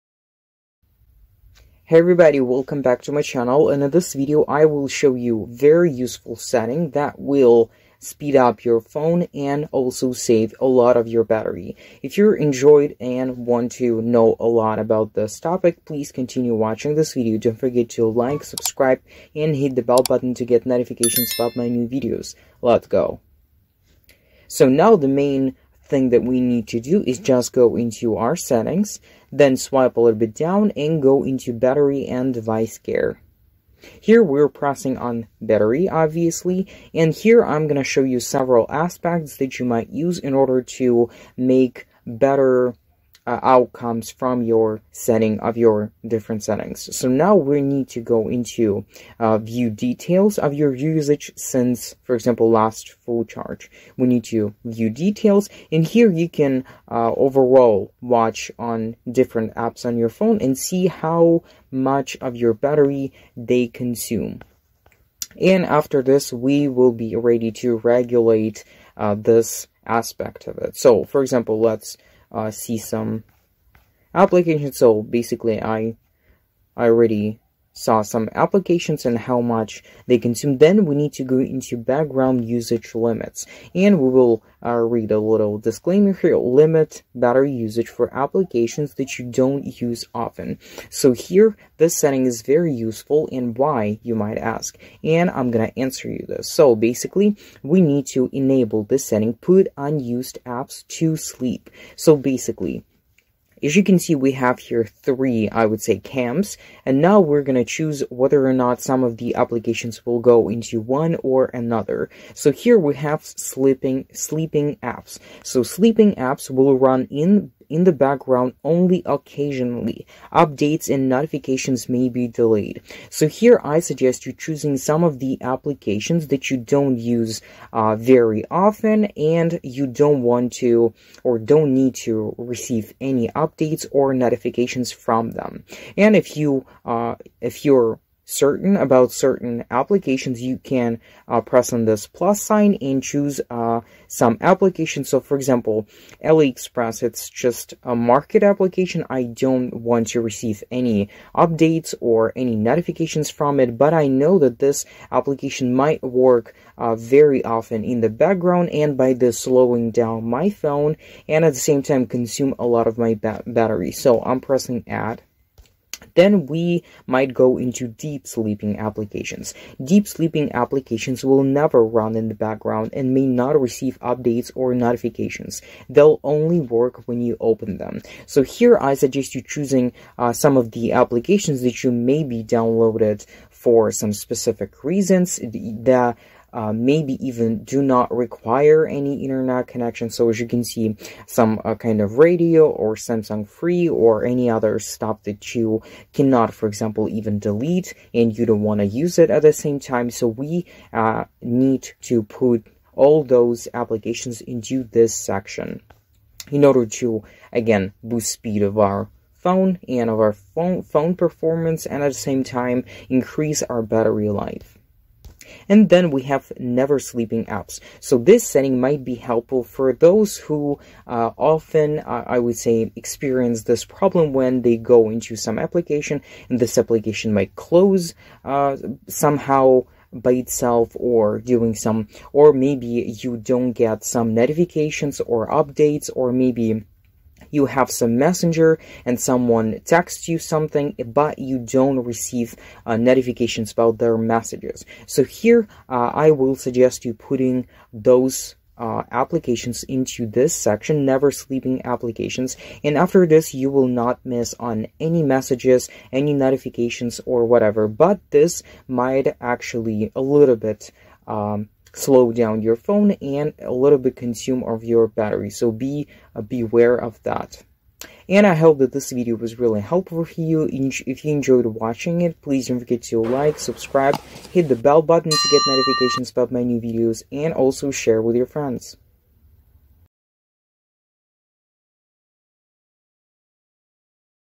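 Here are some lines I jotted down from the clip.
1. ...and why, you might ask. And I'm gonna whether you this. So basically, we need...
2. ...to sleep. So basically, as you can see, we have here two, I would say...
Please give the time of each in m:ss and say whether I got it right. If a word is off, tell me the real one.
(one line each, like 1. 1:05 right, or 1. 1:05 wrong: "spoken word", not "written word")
1. 1:33 wrong: "answer", not "whether"
2. 1:40 wrong: "three", not "two".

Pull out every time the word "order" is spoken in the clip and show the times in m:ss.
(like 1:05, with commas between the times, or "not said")
0:40, 3:26.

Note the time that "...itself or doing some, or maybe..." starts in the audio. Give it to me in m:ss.
3:50.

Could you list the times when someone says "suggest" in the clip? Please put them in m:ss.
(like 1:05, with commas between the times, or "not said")
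2:03, 2:58, 4:06.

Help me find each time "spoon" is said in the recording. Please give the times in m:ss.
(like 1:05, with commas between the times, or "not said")
not said.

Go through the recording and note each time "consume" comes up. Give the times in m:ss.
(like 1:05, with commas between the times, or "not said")
1:03, 1:20, 2:42, 4:24.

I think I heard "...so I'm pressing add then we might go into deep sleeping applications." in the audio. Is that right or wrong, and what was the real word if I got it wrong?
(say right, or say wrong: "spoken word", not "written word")
right.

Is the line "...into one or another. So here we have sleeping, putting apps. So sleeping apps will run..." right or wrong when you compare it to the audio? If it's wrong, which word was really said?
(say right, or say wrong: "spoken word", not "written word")
wrong: "sleeping", not "putting".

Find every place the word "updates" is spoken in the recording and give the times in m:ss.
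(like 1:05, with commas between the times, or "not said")
2:00, 2:13, 2:31, 2:53, 3:55.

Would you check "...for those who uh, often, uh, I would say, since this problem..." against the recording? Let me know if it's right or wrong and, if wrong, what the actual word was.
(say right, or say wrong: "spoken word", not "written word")
wrong: "experience", not "since".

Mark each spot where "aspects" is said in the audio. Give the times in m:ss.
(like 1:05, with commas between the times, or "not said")
0:38, 1:09.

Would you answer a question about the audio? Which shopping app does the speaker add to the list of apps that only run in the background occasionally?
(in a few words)
AliExpress.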